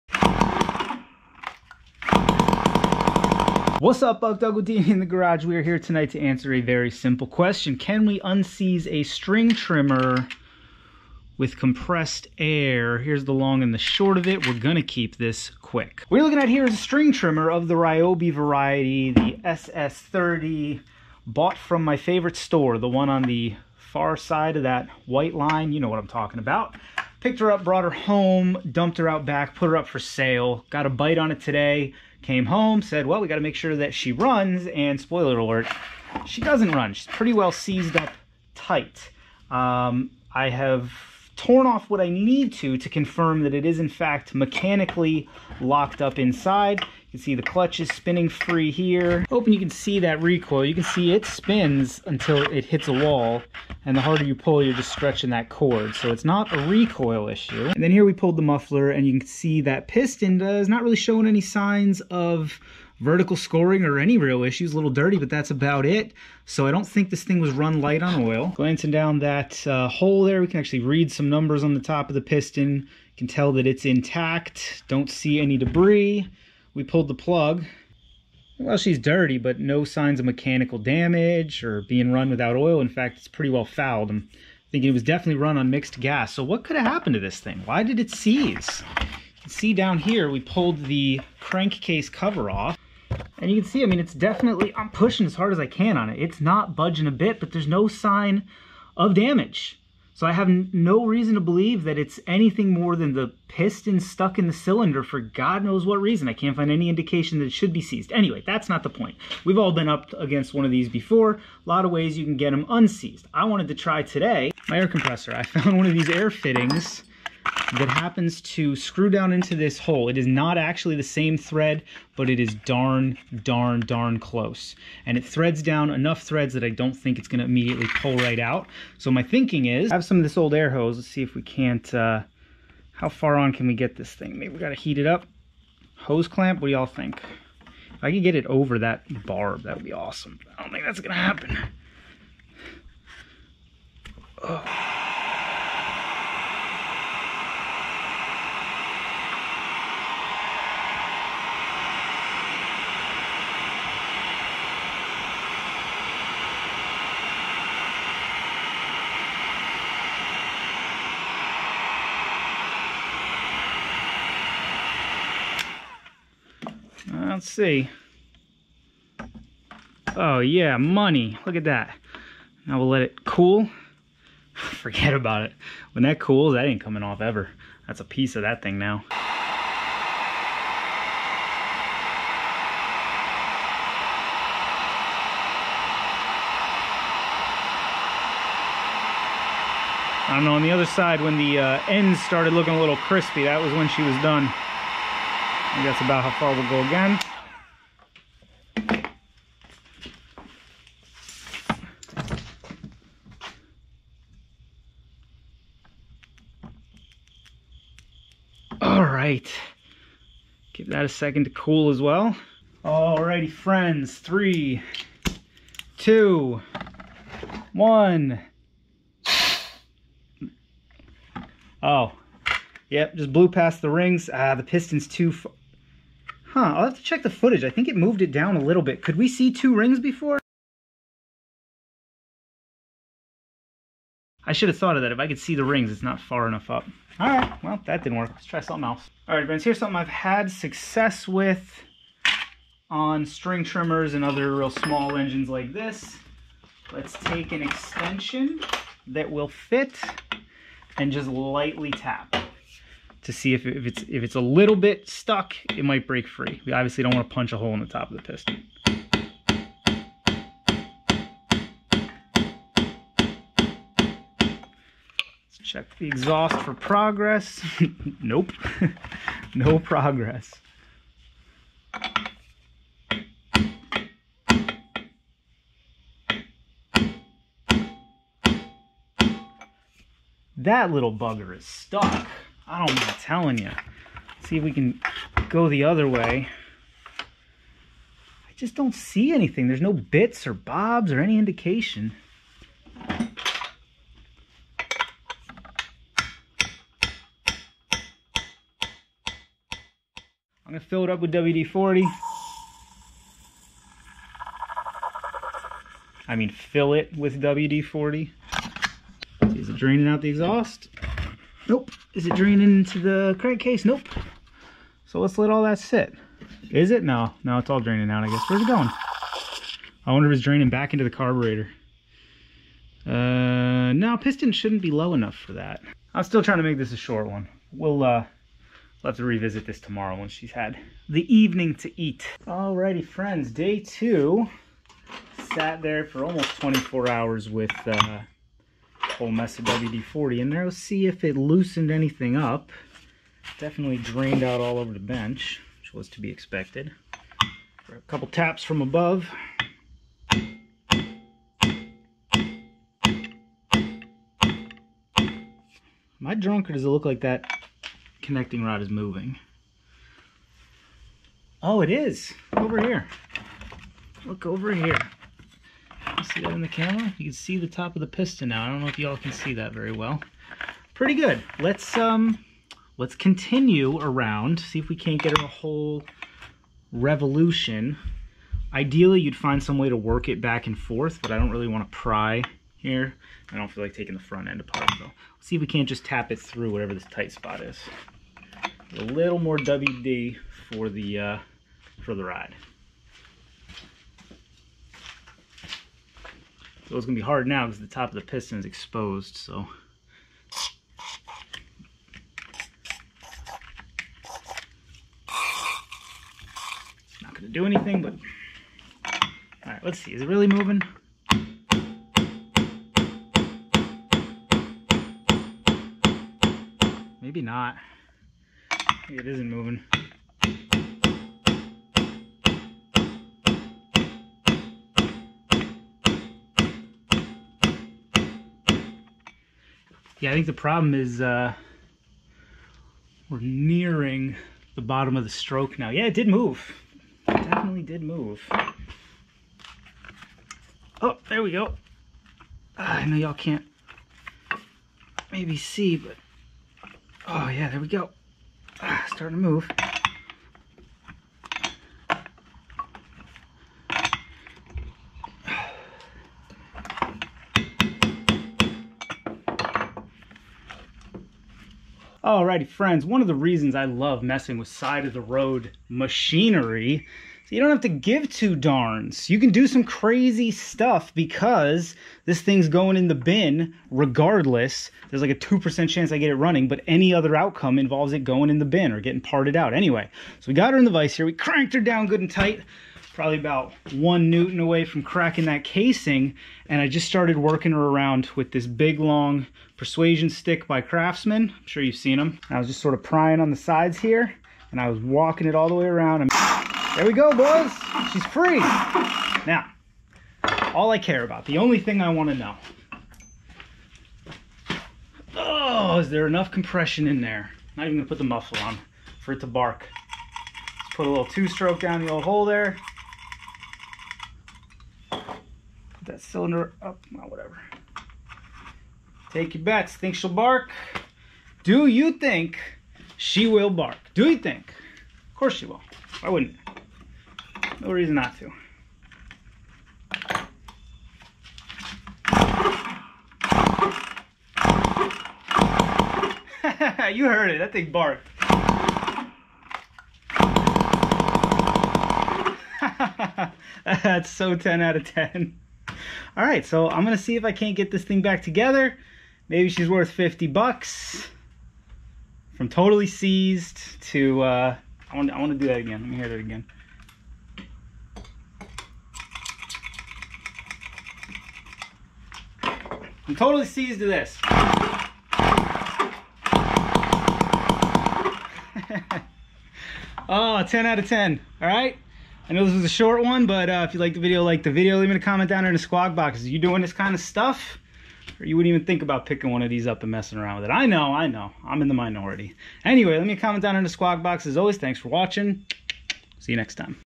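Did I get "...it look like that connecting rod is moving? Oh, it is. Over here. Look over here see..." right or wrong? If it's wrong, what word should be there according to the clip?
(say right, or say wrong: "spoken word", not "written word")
right.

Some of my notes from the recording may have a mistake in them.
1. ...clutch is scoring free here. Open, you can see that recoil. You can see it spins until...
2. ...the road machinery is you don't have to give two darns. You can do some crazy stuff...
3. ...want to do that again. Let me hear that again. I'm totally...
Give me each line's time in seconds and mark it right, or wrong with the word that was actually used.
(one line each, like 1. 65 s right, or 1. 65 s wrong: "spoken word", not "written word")
1. 47 s wrong: "spinning", not "scoring"
2. 465 s right
3. 555 s right.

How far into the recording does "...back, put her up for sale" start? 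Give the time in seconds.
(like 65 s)
29 s.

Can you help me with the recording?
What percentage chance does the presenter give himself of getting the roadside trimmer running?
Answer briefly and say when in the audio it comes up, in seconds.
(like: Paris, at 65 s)
2%, at 475 s.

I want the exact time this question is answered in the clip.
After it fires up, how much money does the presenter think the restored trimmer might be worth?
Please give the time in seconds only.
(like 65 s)
550 s.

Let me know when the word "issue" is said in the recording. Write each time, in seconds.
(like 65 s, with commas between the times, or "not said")
57 s, 64 s.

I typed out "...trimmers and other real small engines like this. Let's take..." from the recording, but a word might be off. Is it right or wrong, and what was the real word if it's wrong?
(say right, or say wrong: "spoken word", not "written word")
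right.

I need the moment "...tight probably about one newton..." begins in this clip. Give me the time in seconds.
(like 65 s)
482 s.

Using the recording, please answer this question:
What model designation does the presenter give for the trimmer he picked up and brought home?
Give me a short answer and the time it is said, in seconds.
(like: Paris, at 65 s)
SS30, at 19 s.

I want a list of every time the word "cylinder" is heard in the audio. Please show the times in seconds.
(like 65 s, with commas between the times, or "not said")
104 s, 516 s.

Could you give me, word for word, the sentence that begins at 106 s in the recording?
I can't find any indication that it should be seized.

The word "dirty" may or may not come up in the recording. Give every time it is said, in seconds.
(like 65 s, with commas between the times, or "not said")
64 s, 78 s.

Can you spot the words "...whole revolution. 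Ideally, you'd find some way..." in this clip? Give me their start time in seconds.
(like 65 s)
375 s.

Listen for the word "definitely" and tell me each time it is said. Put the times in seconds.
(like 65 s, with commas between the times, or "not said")
85 s, 94 s, 343 s, 437 s.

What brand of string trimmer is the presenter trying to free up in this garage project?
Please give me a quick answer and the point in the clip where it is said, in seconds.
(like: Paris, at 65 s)
Ryobi, at 17 s.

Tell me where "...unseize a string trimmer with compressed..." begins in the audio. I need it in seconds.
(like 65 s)
8 s.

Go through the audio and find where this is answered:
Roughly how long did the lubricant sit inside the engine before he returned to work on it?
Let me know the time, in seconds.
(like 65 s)
336 s.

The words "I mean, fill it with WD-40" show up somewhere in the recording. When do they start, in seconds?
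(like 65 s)
306 s.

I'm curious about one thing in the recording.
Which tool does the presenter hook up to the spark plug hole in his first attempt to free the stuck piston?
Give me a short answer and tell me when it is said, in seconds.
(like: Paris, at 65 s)
air compressor, at 114 s.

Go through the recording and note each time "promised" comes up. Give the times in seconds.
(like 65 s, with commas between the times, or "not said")
not said.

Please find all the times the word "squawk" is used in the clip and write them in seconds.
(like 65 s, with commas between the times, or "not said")
575 s, 583 s.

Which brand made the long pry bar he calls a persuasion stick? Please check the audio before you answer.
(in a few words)
Craftsman.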